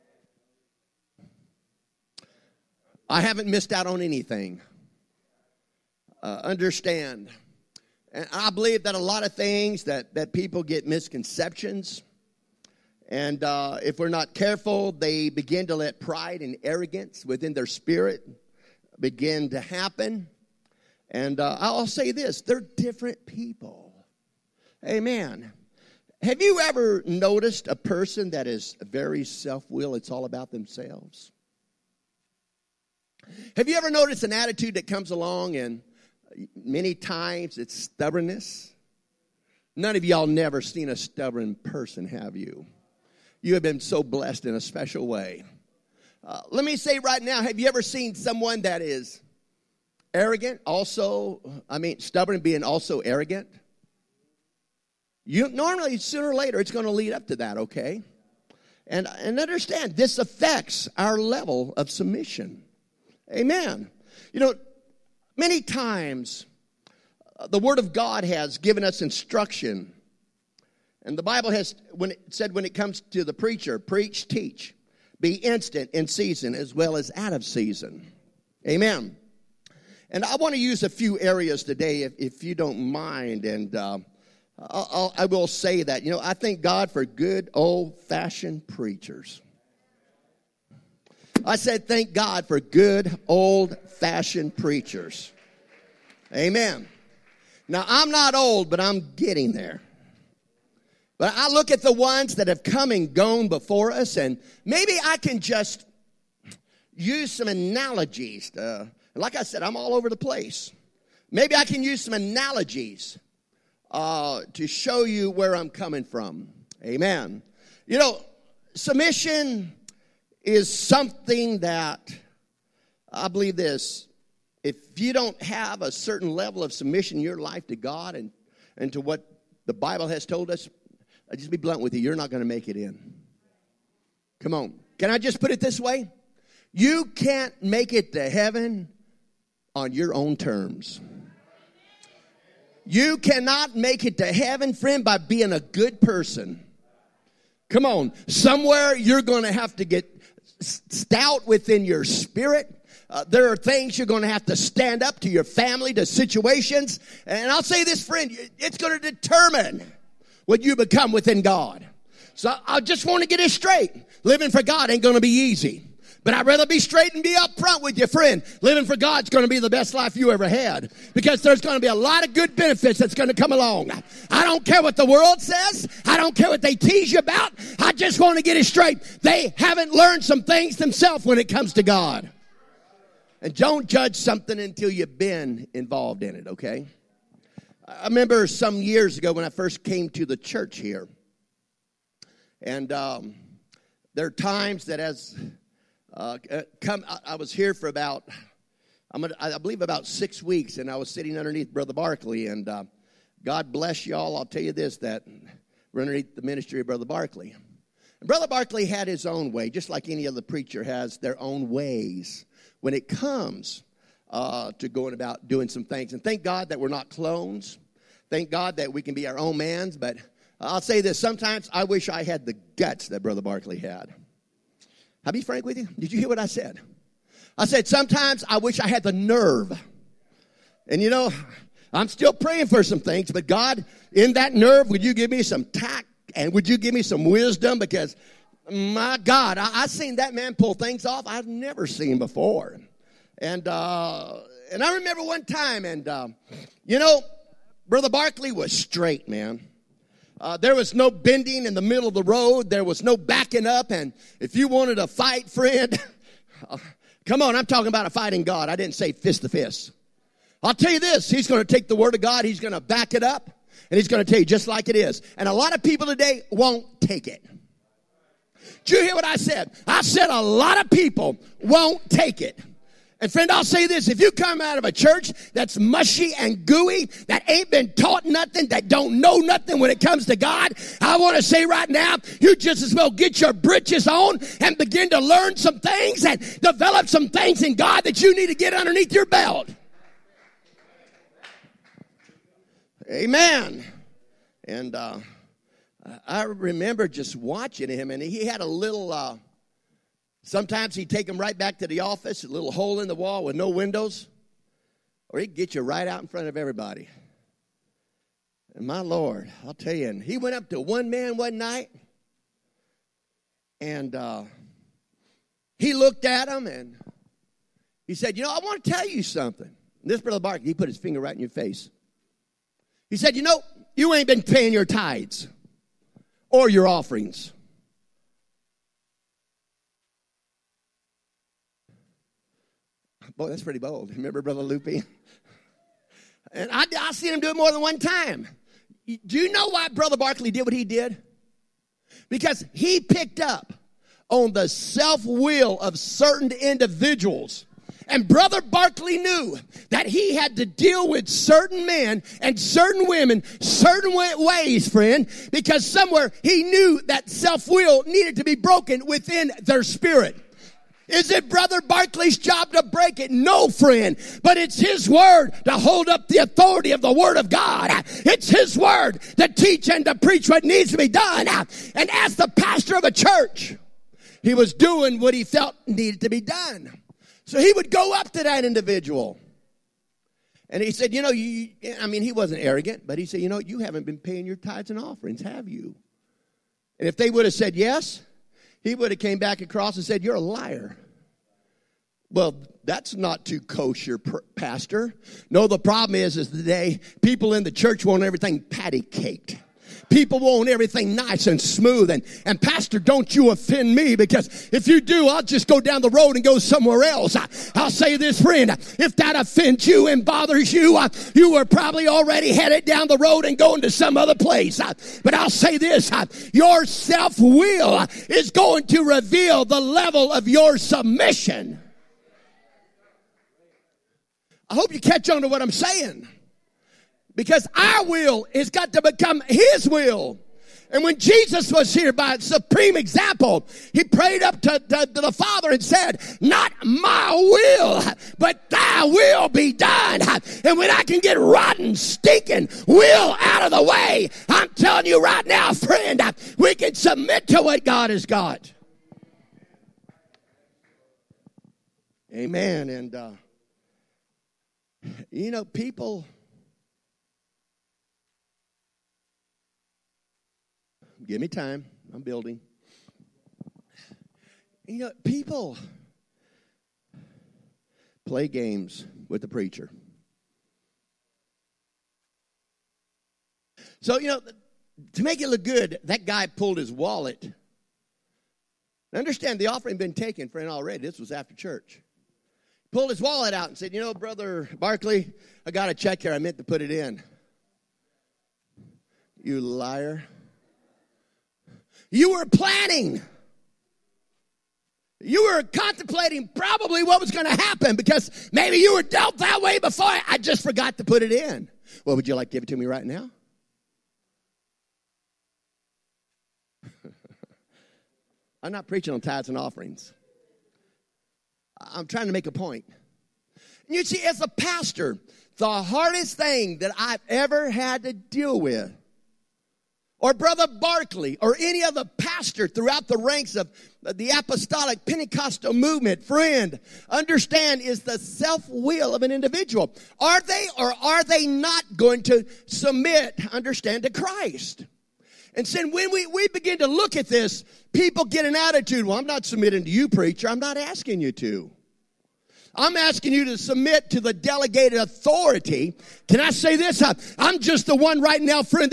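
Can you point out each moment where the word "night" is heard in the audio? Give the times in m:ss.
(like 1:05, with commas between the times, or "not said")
5:11.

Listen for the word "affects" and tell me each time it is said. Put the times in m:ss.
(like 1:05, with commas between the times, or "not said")
1:00.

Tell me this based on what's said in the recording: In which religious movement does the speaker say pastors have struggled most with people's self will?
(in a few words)
apostolic Pentecostal movement.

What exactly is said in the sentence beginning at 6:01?
Is it Brother Barkley's job to break it?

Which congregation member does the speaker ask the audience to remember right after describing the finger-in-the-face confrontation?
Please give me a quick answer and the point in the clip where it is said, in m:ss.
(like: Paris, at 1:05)
Brother Loopy, at 5:34.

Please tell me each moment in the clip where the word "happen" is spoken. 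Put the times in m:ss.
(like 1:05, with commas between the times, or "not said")
0:19, 8:17.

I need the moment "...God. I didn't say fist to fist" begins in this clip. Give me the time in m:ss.
4:18.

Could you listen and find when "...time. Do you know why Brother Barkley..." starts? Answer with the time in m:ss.
5:37.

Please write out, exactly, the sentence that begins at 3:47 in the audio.
I said, sometimes I wish I had the nerve.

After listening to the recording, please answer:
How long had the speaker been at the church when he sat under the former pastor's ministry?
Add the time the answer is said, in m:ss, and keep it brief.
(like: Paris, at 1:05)
6 weeks, at 3:20.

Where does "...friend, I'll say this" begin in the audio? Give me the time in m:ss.
4:33.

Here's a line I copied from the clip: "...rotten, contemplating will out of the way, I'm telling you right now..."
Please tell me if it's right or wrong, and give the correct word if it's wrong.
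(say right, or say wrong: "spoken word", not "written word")
wrong: "stinking", not "contemplating".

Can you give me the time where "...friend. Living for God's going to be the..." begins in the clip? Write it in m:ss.
2:48.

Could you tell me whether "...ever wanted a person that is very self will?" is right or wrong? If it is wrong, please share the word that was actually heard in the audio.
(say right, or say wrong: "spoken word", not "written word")
wrong: "noticed", not "wanted".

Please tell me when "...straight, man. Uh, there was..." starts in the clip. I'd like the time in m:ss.
4:08.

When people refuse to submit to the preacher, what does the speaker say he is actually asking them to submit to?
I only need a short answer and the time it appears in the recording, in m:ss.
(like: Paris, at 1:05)
the delegated authority, at 9:04.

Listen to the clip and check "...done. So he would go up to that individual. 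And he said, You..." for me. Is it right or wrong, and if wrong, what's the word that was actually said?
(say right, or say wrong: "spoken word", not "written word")
right.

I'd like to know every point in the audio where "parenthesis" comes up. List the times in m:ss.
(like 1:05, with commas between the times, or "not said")
not said.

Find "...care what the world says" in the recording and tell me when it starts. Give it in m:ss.
2:54.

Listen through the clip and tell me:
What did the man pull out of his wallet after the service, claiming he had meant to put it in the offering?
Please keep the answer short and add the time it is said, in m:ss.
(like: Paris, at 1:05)
a check, at 8:05.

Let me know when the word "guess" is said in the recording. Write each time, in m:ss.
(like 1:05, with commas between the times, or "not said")
not said.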